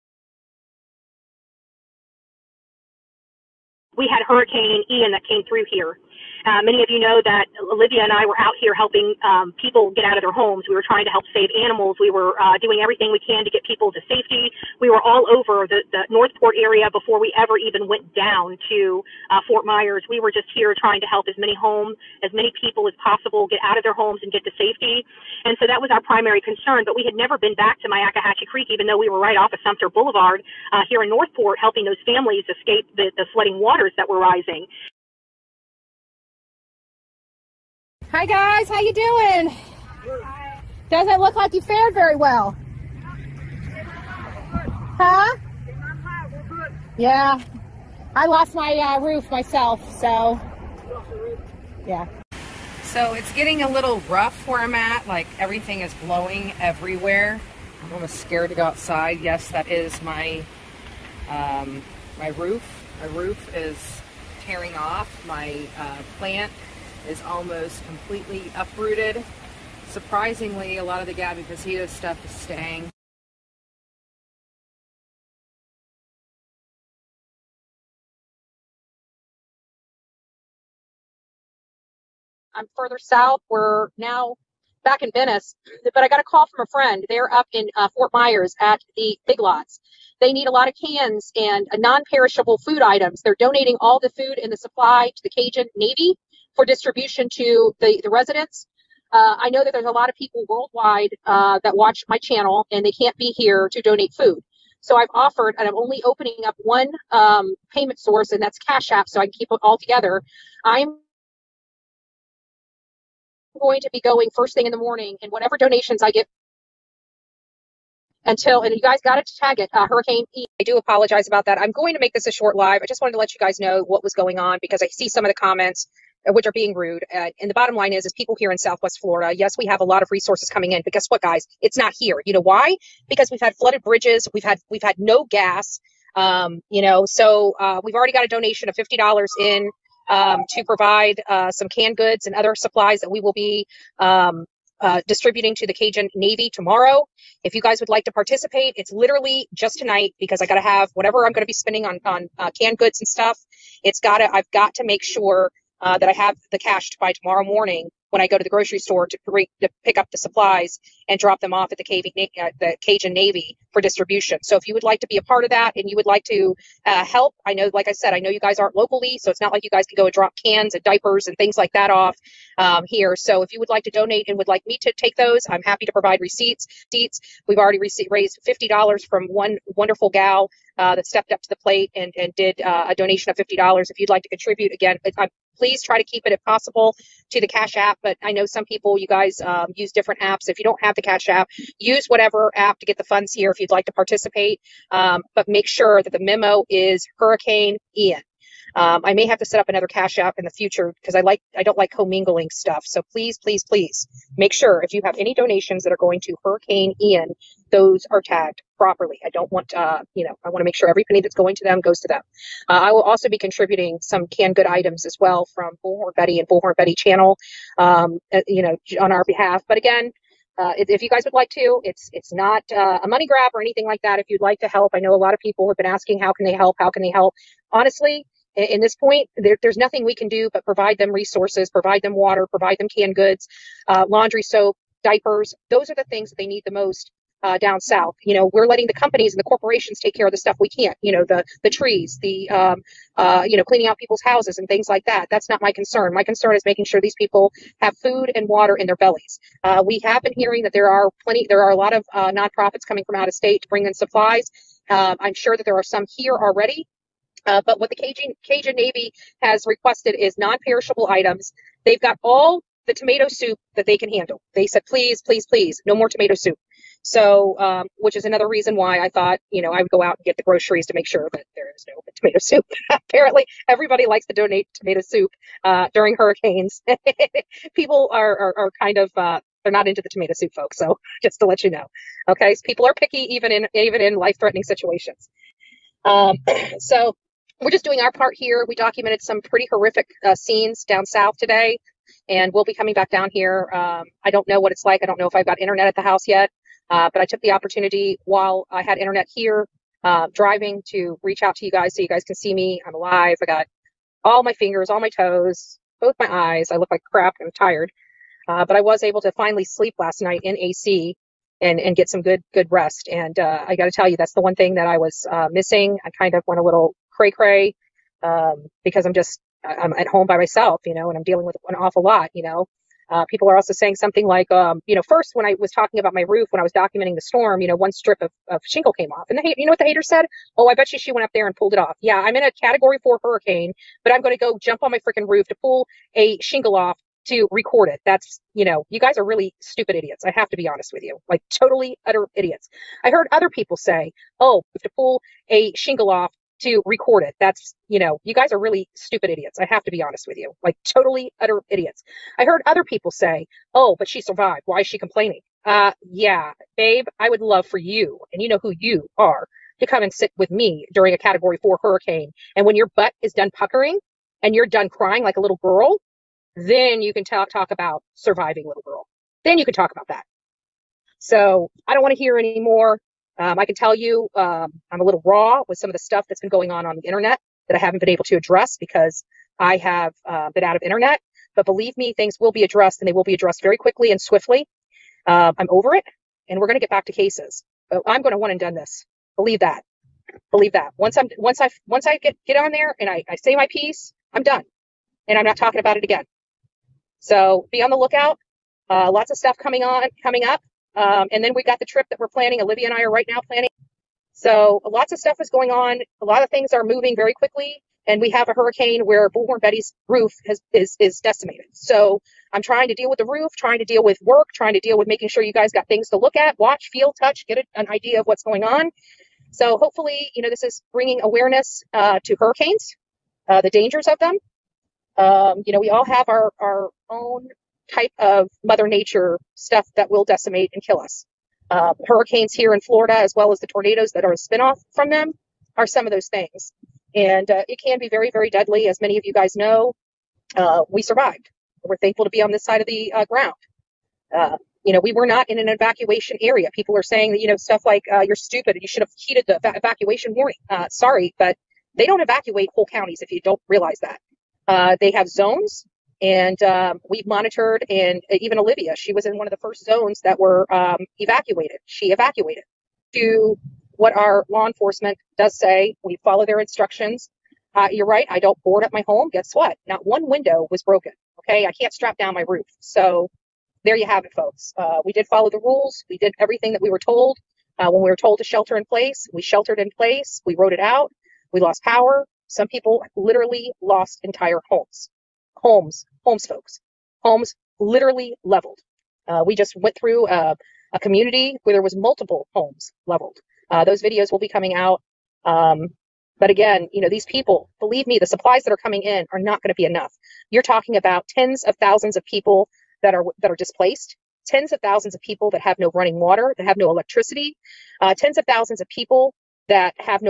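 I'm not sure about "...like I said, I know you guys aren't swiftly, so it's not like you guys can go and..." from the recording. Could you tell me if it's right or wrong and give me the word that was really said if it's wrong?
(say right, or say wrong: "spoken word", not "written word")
wrong: "locally", not "swiftly".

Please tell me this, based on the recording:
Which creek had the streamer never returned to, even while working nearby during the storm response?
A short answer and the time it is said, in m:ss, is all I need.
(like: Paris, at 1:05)
Myakkahatchee Creek, at 0:27.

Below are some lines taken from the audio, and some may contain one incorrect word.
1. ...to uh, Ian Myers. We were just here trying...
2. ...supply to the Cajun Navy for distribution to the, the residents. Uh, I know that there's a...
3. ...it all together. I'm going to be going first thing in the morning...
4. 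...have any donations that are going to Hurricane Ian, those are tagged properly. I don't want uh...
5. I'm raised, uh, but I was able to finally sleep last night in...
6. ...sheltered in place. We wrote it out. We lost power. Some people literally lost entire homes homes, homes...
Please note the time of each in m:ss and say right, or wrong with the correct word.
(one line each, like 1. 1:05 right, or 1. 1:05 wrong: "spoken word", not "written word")
1. 0:18 wrong: "Fort", not "Ian"
2. 1:34 right
3. 1:49 right
4. 3:25 right
5. 5:07 wrong: "tired", not "raised"
6. 7:59 right.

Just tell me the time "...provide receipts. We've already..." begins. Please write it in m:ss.
2:55.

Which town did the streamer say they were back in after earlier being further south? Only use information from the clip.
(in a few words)
Venice.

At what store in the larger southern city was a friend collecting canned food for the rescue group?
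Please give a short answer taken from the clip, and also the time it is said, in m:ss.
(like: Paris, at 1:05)
Big Lots, at 1:29.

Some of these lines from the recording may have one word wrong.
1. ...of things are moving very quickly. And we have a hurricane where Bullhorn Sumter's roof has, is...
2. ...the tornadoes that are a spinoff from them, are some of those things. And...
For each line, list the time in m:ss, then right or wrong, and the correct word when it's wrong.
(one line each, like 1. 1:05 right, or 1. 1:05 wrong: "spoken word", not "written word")
1. 6:46 wrong: "Betty", not "Sumter"
2. 7:13 right.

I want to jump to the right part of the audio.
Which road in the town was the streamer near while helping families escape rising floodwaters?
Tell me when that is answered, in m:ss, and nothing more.
0:29.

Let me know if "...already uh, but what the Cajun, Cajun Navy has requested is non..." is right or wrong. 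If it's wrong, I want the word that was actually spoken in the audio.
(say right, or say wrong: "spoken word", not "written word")
right.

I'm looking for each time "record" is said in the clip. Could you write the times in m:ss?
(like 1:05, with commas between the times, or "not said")
5:37, 5:46.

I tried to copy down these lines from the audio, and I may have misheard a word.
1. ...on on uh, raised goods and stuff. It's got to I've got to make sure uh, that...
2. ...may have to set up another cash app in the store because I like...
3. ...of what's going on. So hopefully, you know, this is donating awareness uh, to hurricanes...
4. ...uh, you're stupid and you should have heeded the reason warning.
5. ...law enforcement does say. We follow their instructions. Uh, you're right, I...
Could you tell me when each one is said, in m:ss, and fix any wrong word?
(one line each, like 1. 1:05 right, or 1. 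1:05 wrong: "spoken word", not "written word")
1. 2:31 wrong: "canned", not "raised"
2. 3:19 wrong: "future", not "store"
3. 6:58 wrong: "bringing", not "donating"
4. 7:28 wrong: "evacuation", not "reason"
5. 7:44 right.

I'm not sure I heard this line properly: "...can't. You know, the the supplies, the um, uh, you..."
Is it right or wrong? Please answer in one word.
wrong.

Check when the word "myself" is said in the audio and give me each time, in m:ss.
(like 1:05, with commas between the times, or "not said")
0:49, 5:20.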